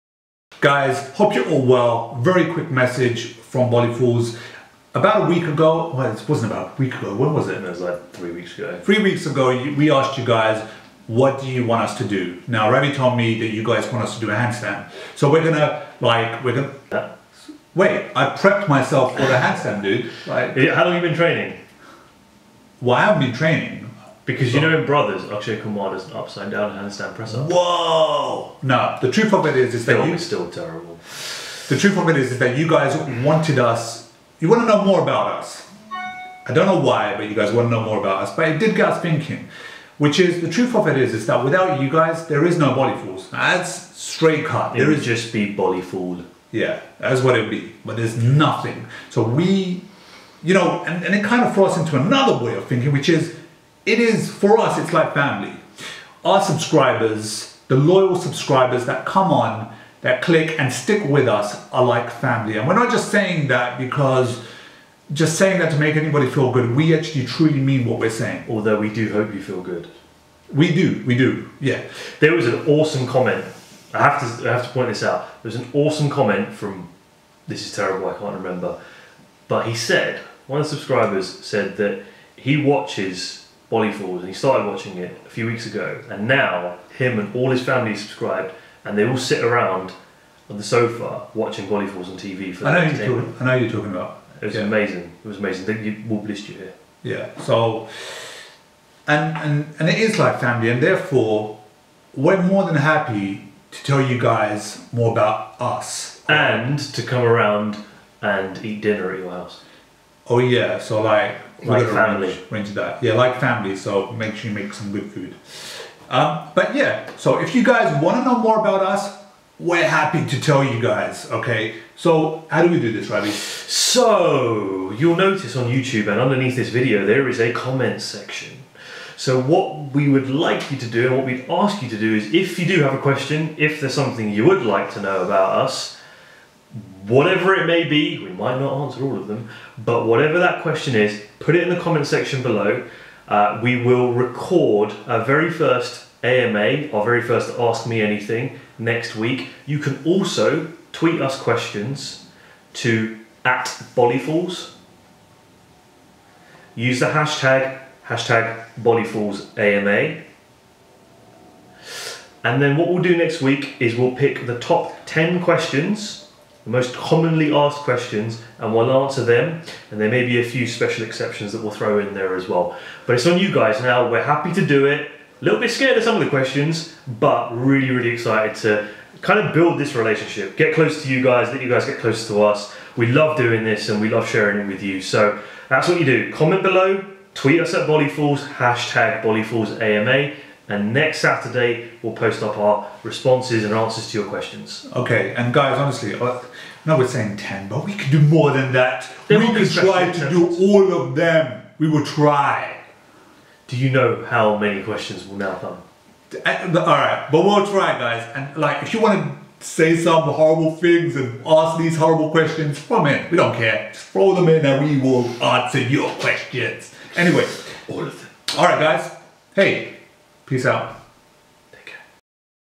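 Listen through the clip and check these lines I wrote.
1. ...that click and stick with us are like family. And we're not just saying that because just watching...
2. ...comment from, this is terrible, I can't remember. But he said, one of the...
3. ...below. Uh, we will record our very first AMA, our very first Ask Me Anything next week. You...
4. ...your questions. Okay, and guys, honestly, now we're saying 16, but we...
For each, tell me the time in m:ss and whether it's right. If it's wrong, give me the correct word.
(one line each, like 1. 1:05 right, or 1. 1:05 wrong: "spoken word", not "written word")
1. 1:00 wrong: "saying", not "watching"
2. 1:16 right
3. 2:22 right
4. 3:14 wrong: "10", not "16".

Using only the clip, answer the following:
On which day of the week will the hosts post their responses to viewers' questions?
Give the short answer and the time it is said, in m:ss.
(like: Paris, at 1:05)
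Saturday, at 3:11.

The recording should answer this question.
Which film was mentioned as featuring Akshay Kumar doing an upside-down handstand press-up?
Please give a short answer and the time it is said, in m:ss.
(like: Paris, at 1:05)
Brothers, at 0:24.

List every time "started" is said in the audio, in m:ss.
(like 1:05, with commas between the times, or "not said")
1:24.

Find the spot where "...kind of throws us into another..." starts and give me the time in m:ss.
0:51.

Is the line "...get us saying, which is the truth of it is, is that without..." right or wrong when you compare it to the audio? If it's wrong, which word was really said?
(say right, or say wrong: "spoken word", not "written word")
wrong: "thinking", not "saying".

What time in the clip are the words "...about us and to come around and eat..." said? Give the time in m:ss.
1:45.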